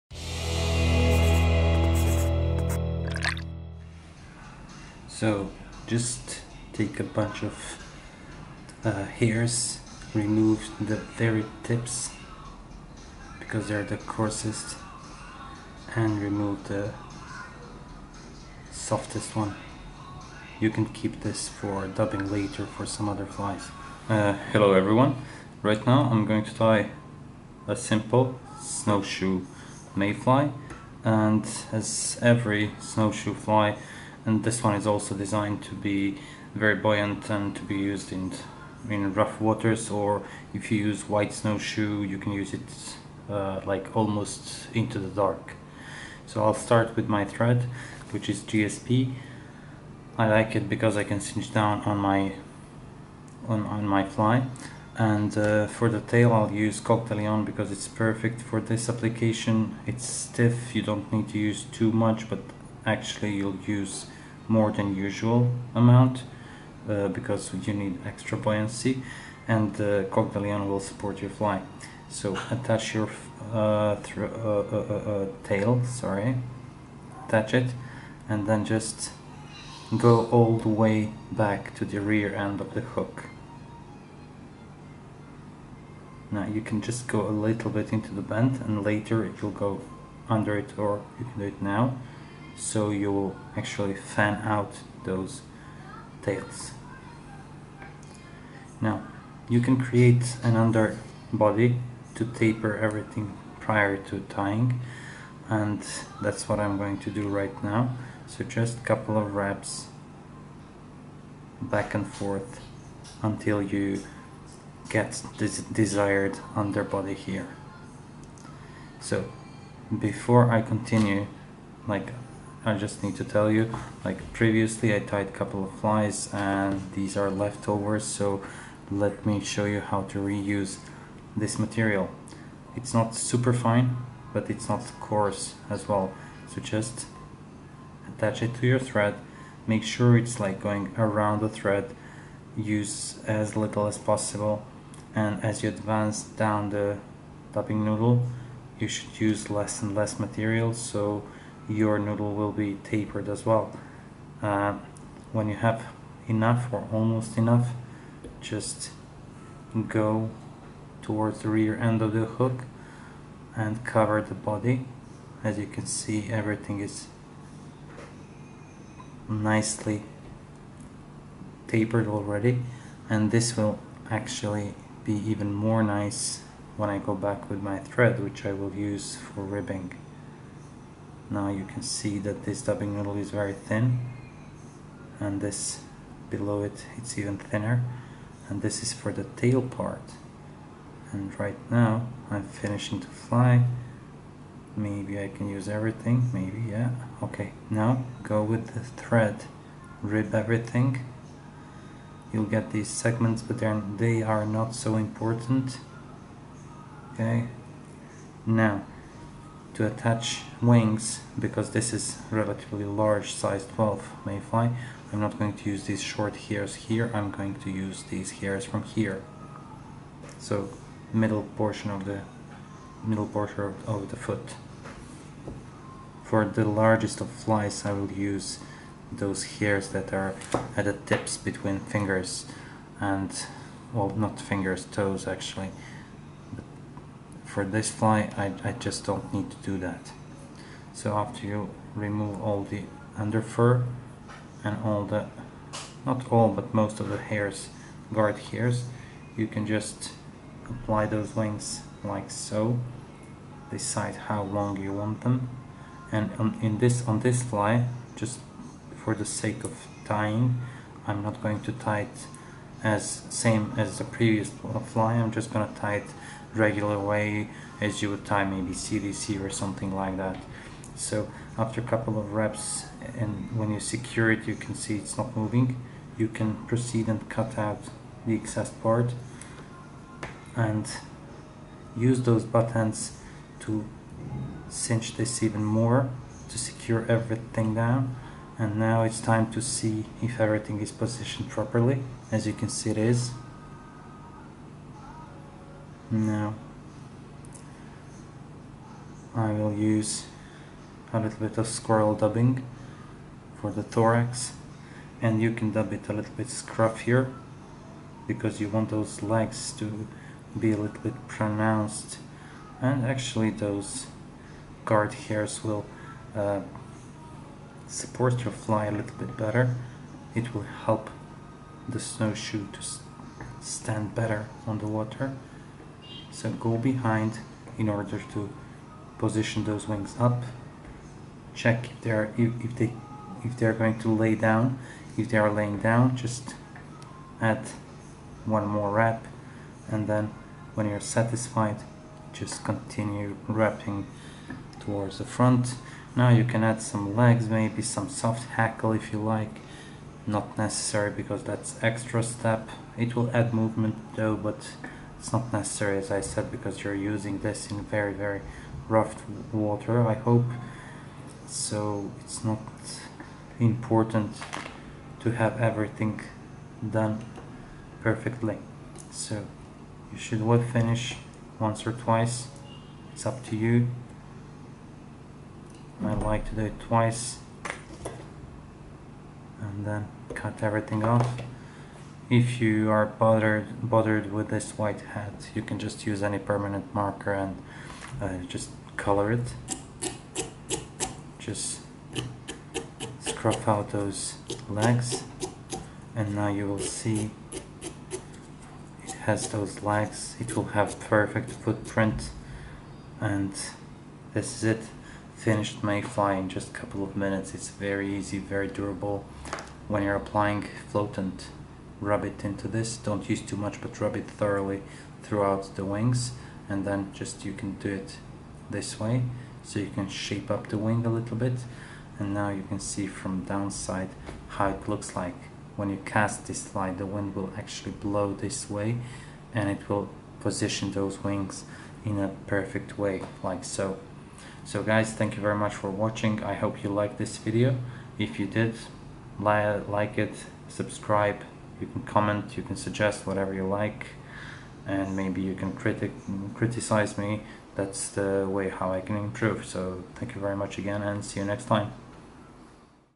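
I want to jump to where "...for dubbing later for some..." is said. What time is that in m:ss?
0:21.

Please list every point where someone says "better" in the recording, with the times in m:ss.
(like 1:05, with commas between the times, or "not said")
5:19, 5:24.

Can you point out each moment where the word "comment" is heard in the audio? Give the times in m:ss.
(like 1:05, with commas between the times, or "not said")
7:22.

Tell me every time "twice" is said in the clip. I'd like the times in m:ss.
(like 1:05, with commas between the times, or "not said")
6:11, 6:16.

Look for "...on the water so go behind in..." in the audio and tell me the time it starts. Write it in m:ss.
5:24.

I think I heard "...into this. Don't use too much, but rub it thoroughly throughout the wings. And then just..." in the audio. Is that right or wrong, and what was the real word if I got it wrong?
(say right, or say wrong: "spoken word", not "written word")
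right.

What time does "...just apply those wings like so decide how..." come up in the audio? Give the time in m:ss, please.
4:09.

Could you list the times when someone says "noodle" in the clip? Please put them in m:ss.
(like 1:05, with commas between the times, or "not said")
2:27, 2:31.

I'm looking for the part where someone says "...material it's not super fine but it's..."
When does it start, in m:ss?
2:11.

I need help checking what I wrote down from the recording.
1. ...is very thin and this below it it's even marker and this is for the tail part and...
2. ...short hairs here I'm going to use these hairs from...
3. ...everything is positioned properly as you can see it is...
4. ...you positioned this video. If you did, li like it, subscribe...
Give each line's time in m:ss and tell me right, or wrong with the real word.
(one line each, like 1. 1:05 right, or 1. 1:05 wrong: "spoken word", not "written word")
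1. 3:03 wrong: "thinner", not "marker"
2. 3:36 right
3. 4:50 right
4. 7:16 wrong: "liked", not "positioned".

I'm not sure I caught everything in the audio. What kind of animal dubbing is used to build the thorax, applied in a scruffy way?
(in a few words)
squirrel.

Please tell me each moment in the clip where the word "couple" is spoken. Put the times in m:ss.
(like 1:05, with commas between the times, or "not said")
1:48, 2:05, 4:31, 6:46.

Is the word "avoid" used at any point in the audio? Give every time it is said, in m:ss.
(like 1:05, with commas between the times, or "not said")
not said.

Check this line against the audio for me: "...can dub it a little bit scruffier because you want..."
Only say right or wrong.
right.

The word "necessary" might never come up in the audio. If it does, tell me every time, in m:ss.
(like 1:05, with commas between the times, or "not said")
5:50, 5:55.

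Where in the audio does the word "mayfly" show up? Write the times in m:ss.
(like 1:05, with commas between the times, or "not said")
0:29, 3:34, 6:45.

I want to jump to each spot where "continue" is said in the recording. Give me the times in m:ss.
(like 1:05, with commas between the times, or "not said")
2:00, 5:42.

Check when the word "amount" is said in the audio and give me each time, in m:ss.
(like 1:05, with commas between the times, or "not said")
1:05.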